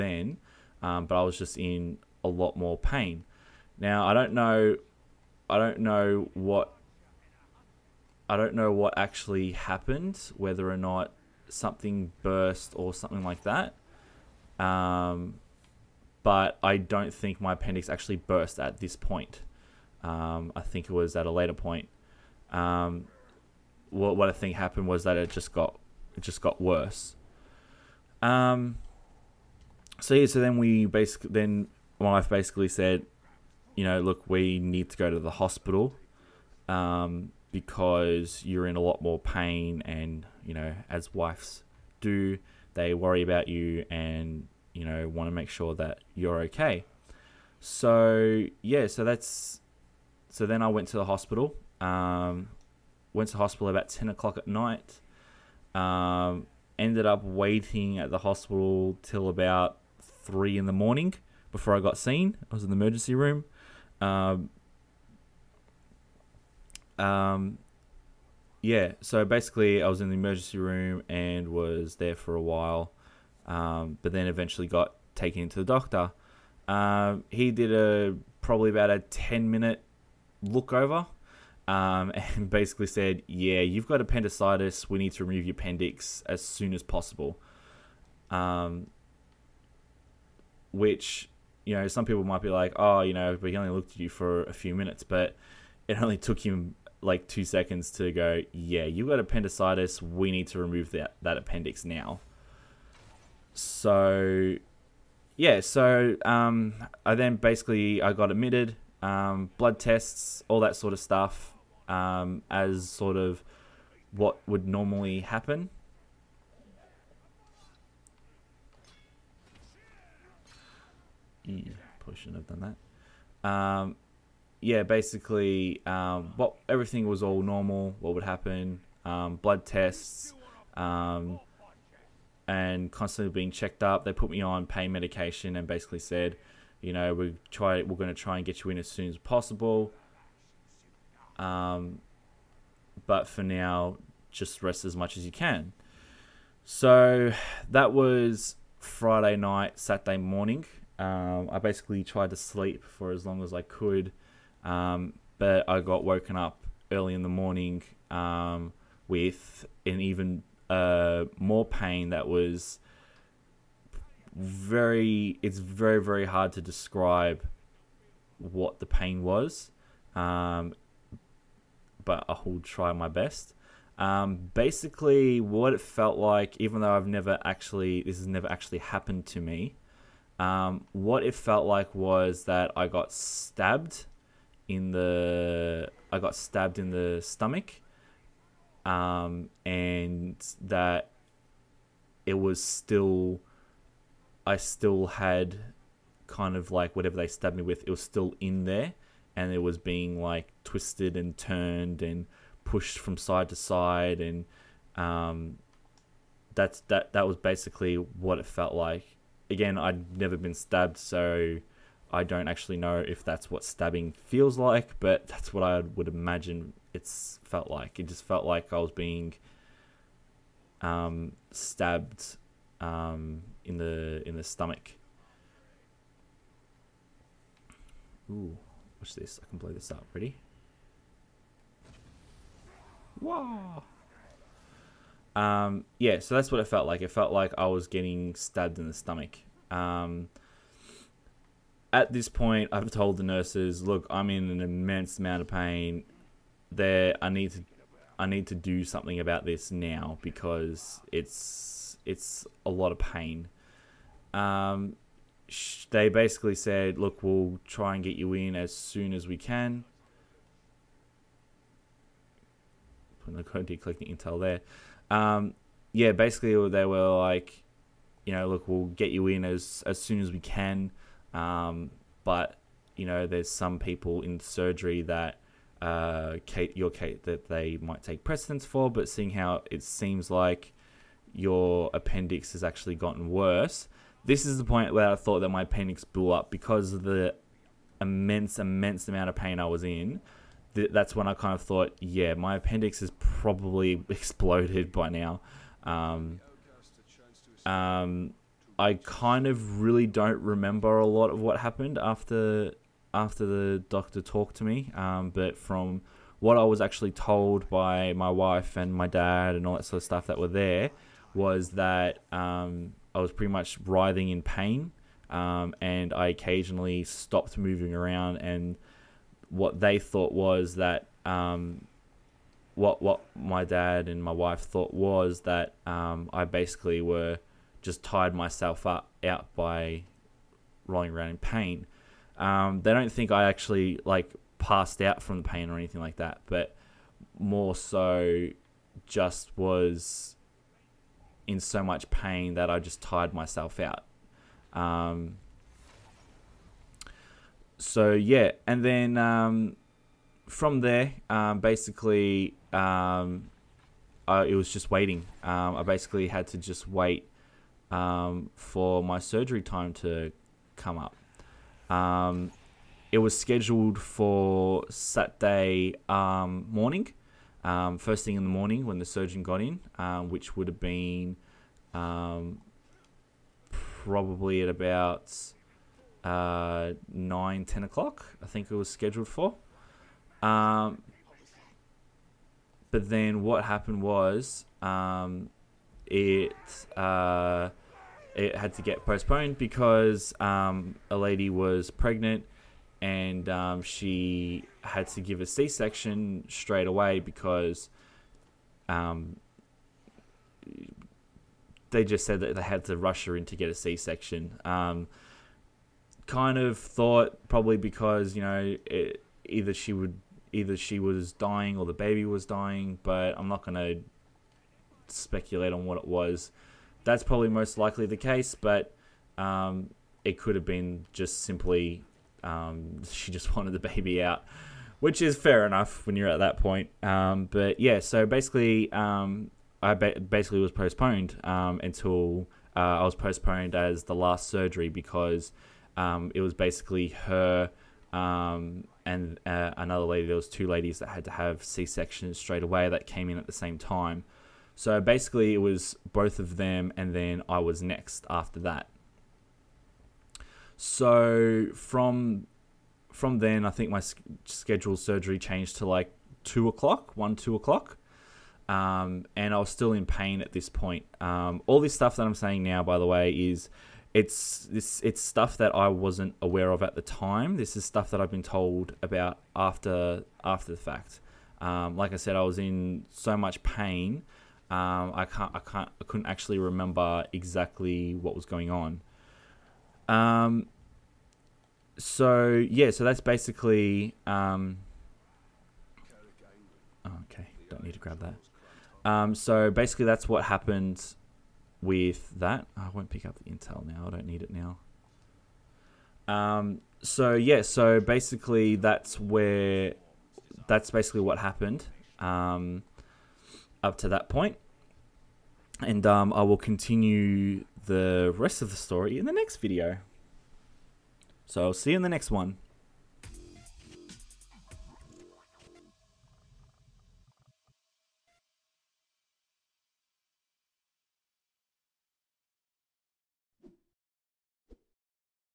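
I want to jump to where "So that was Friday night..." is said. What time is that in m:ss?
2:26.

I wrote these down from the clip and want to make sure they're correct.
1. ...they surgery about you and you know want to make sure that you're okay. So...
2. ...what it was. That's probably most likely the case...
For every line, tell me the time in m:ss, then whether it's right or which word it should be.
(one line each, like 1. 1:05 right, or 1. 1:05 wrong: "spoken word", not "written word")
1. 0:42 wrong: "worry", not "surgery"
2. 6:55 right.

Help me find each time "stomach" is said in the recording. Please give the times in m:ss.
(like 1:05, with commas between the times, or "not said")
3:07, 3:44, 3:58.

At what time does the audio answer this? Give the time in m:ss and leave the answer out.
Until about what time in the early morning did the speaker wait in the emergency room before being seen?
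1:00.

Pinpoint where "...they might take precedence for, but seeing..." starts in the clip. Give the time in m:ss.
4:37.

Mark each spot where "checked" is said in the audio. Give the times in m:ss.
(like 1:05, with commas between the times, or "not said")
2:13.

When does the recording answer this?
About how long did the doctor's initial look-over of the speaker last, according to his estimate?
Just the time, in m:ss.
1:18.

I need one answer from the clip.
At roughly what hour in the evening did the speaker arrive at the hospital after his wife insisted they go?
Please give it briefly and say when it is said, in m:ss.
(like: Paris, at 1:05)
10 o'clock at night, at 0:53.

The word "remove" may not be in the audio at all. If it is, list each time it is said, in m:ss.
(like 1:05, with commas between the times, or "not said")
1:25, 1:40.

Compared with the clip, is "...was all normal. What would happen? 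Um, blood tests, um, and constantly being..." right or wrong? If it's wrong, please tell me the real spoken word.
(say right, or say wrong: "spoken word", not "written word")
right.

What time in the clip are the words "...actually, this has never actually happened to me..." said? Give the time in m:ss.
2:57.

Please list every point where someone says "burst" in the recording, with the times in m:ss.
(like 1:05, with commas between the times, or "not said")
0:12, 0:18.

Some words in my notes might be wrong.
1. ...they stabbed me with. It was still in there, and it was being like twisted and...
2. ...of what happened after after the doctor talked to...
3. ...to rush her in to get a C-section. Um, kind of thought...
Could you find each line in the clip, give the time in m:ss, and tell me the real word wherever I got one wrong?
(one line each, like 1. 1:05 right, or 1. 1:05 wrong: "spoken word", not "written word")
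1. 3:17 right
2. 5:01 right
3. 6:42 right.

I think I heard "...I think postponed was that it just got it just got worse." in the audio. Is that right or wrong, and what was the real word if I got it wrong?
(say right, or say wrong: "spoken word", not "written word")
wrong: "happened", not "postponed".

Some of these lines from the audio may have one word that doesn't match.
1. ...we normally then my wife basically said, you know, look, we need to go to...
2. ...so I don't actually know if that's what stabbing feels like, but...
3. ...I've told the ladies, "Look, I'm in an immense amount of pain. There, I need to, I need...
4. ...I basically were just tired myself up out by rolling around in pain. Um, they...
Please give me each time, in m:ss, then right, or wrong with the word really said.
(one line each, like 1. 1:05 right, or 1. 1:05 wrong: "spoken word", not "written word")
1. 0:30 wrong: "basically", not "normally"
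2. 3:30 right
3. 4:02 wrong: "nurses", not "ladies"
4. 5:26 right.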